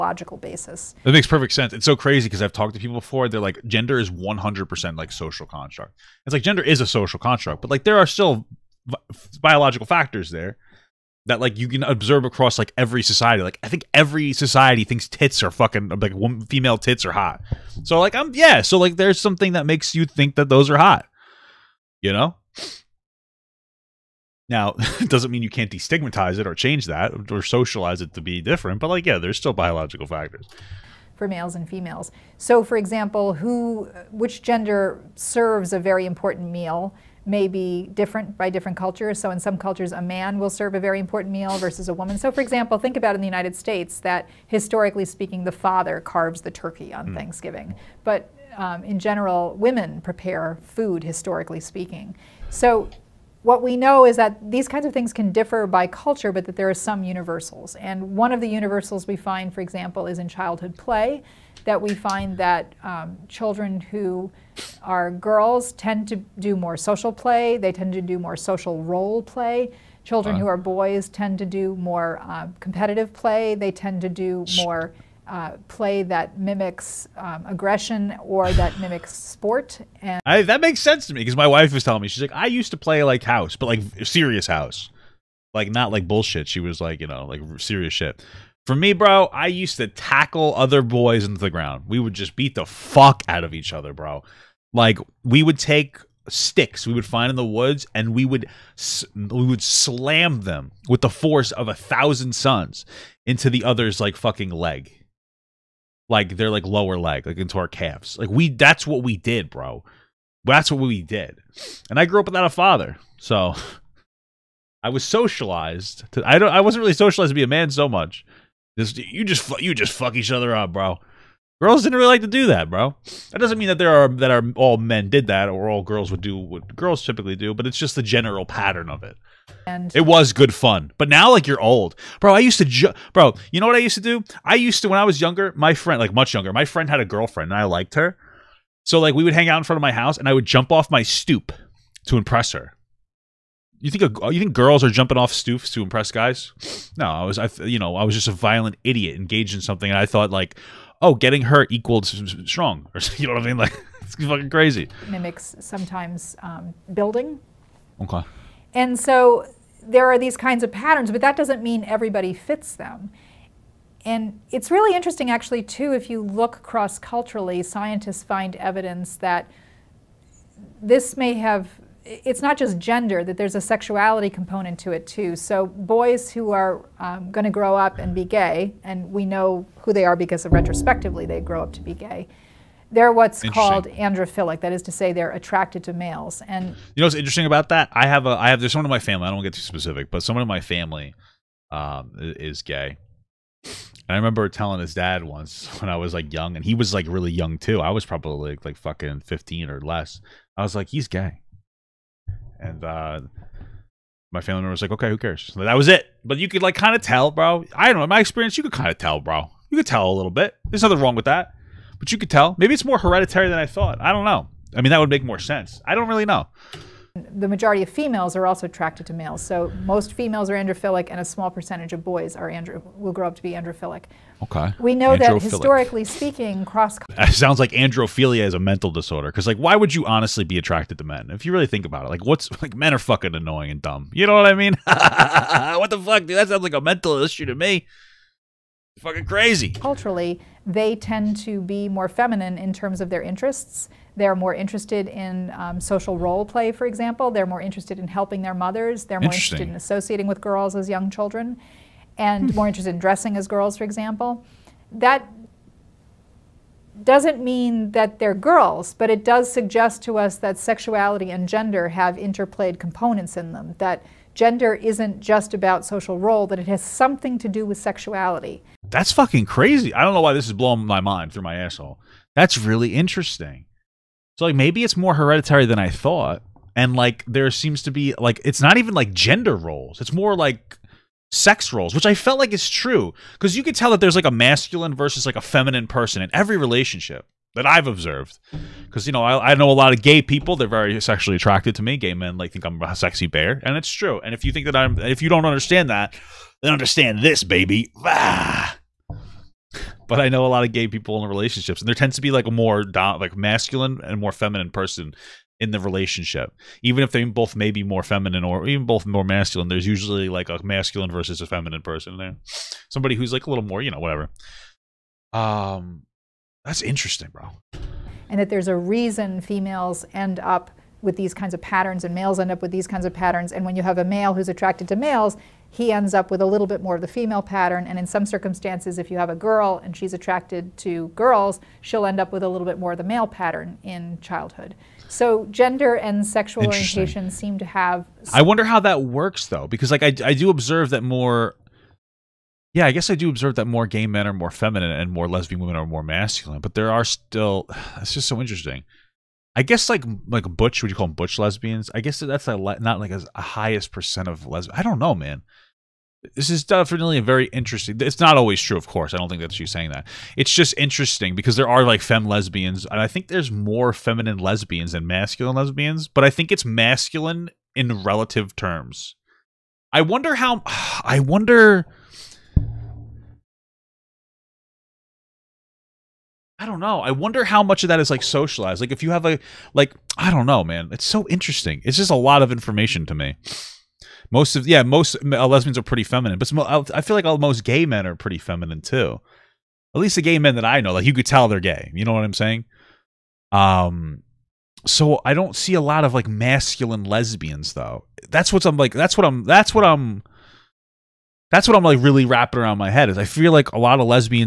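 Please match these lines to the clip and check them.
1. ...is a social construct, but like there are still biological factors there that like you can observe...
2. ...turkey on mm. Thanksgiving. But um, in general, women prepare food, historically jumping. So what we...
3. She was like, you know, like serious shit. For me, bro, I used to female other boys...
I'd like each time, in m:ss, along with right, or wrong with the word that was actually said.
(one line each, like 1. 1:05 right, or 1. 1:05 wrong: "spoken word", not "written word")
1. 0:06 right
2. 0:46 wrong: "speaking", not "jumping"
3. 1:26 wrong: "tackle", not "female".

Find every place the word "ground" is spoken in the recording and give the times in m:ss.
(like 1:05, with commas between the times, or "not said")
1:31.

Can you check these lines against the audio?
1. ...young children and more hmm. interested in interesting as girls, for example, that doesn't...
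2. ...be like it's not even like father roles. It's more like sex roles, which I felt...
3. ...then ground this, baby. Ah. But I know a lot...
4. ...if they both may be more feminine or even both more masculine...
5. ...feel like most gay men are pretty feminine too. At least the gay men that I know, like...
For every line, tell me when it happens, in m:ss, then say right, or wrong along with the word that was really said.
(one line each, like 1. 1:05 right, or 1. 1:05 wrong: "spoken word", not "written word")
1. 4:10 wrong: "dressing", not "interesting"
2. 4:37 wrong: "gender", not "father"
3. 4:56 wrong: "understand", not "ground"
4. 5:07 right
5. 6:26 right.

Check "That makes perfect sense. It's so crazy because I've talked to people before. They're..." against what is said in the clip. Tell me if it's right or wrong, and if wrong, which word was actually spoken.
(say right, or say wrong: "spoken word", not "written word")
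right.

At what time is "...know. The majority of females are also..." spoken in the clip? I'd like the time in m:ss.
3:36.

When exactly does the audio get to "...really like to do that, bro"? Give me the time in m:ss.
2:01.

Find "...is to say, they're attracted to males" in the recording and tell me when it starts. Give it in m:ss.
3:04.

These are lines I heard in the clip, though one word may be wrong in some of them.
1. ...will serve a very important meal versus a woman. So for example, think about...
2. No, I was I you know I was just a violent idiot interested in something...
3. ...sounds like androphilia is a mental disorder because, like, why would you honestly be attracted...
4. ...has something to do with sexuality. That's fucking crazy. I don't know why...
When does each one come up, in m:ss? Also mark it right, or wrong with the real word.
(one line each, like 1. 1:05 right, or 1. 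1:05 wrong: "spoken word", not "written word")
1. 0:40 right
2. 2:26 wrong: "engaged", not "interested"
3. 3:47 right
4. 4:26 right.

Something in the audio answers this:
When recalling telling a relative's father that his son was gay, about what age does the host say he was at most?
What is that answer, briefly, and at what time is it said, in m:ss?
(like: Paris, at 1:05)
15, at 3:19.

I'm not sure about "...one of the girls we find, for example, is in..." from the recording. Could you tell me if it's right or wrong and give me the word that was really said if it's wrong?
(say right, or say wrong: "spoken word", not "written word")
wrong: "universals", not "girls".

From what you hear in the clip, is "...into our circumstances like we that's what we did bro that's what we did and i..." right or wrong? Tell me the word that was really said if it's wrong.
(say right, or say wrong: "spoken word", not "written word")
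wrong: "calves", not "circumstances".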